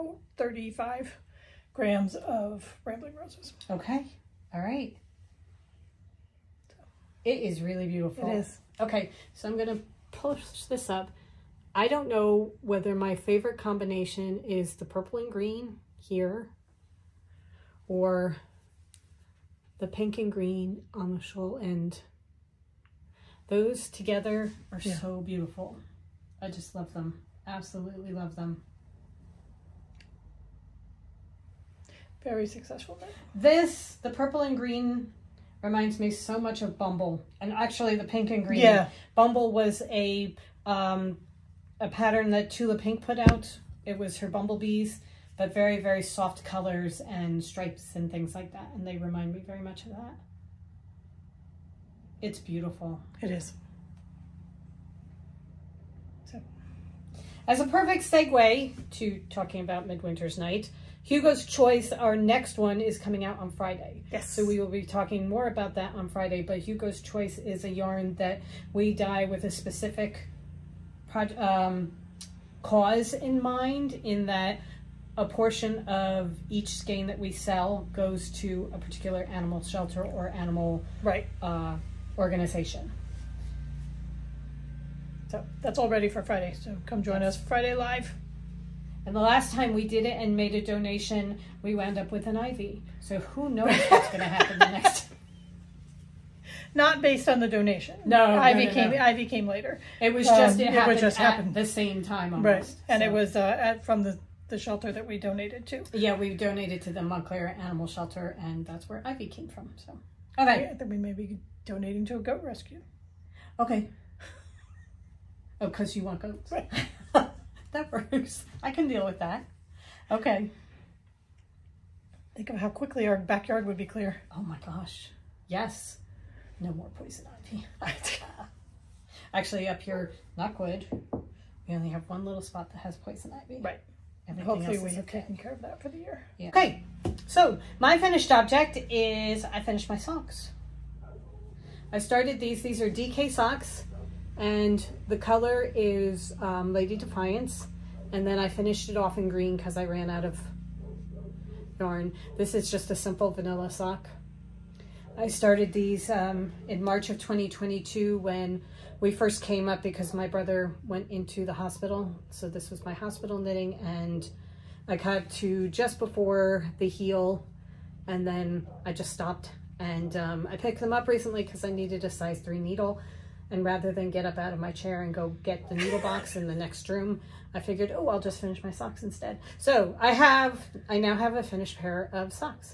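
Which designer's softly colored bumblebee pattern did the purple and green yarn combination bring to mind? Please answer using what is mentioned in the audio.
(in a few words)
Tula Pink.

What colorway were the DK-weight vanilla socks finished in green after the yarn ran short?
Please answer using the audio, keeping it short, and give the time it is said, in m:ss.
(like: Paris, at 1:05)
Lady Defiance, at 2:26.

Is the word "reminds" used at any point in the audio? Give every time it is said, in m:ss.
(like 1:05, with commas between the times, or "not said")
0:35, 0:48.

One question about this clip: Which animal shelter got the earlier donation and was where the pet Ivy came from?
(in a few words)
Montclair Animal Shelter.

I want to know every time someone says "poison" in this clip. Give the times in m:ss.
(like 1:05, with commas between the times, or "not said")
2:06, 2:12.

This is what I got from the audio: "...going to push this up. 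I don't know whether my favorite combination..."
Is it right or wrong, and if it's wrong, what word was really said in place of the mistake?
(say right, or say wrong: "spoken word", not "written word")
right.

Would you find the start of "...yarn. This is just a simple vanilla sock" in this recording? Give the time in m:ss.
2:31.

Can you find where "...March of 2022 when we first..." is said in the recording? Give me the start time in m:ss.
2:36.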